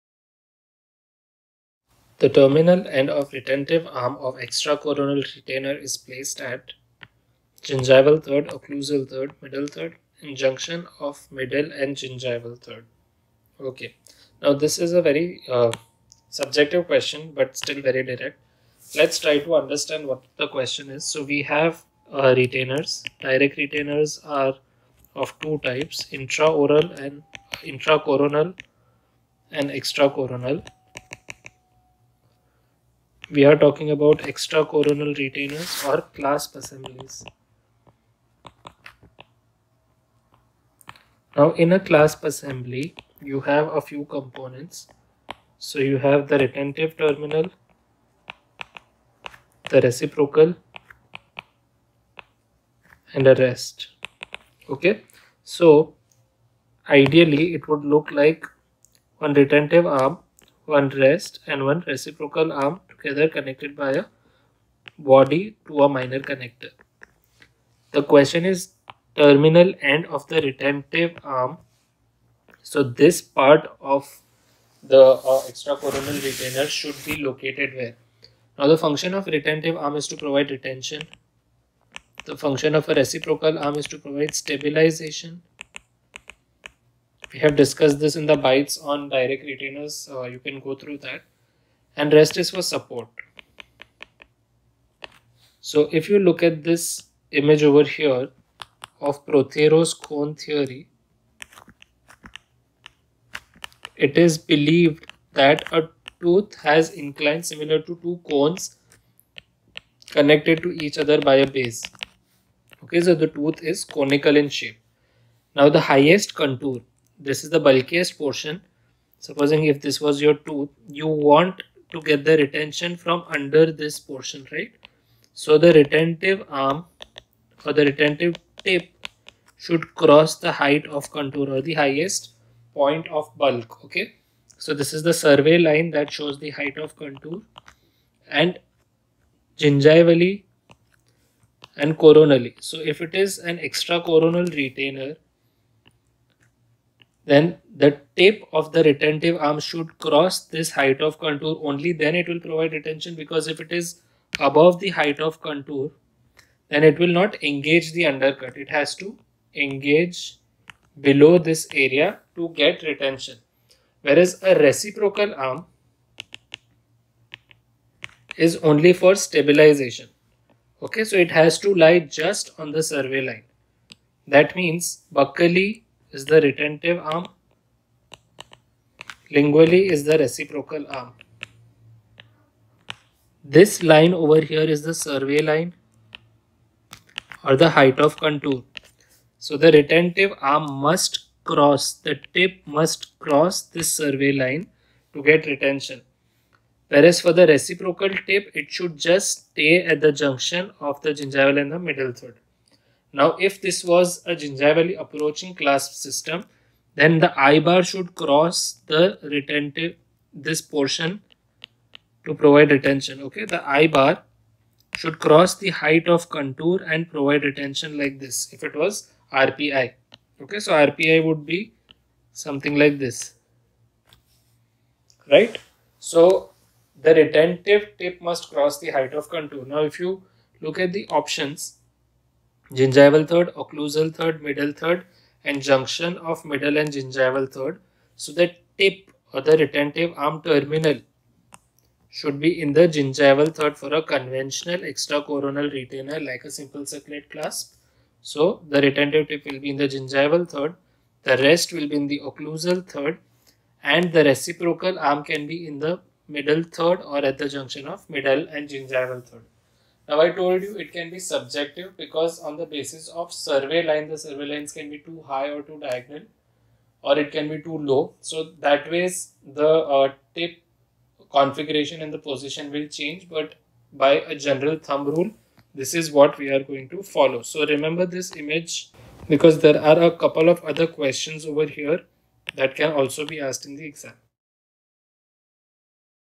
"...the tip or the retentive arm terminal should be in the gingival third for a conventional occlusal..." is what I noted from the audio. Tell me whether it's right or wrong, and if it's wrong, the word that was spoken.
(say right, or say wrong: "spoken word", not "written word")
wrong: "extracoronal", not "occlusal".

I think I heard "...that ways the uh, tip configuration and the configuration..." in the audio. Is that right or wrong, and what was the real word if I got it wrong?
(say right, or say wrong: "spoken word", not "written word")
wrong: "position", not "configuration".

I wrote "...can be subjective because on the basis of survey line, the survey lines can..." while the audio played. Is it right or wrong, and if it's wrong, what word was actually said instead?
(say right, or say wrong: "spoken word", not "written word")
right.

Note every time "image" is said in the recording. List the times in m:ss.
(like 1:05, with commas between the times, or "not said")
1:37, 4:38.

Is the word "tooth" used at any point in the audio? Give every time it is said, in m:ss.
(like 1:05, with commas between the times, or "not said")
1:46, 1:53, 2:00.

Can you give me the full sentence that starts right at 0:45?
So you have the retentive terminal, the reciprocal, and a rest.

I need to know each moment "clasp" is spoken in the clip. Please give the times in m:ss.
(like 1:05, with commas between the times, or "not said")
0:36, 0:41, 3:25, 4:07.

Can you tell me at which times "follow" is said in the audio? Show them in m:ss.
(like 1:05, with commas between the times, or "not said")
4:37.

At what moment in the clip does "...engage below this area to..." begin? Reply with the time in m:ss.
2:39.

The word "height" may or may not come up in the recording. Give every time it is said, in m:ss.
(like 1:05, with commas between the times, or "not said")
2:10, 2:16, 2:30, 2:34, 3:07, 3:35, 3:48.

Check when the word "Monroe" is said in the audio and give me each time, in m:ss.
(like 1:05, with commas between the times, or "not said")
not said.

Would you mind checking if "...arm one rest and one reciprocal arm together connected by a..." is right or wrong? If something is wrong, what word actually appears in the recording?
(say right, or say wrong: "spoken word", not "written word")
right.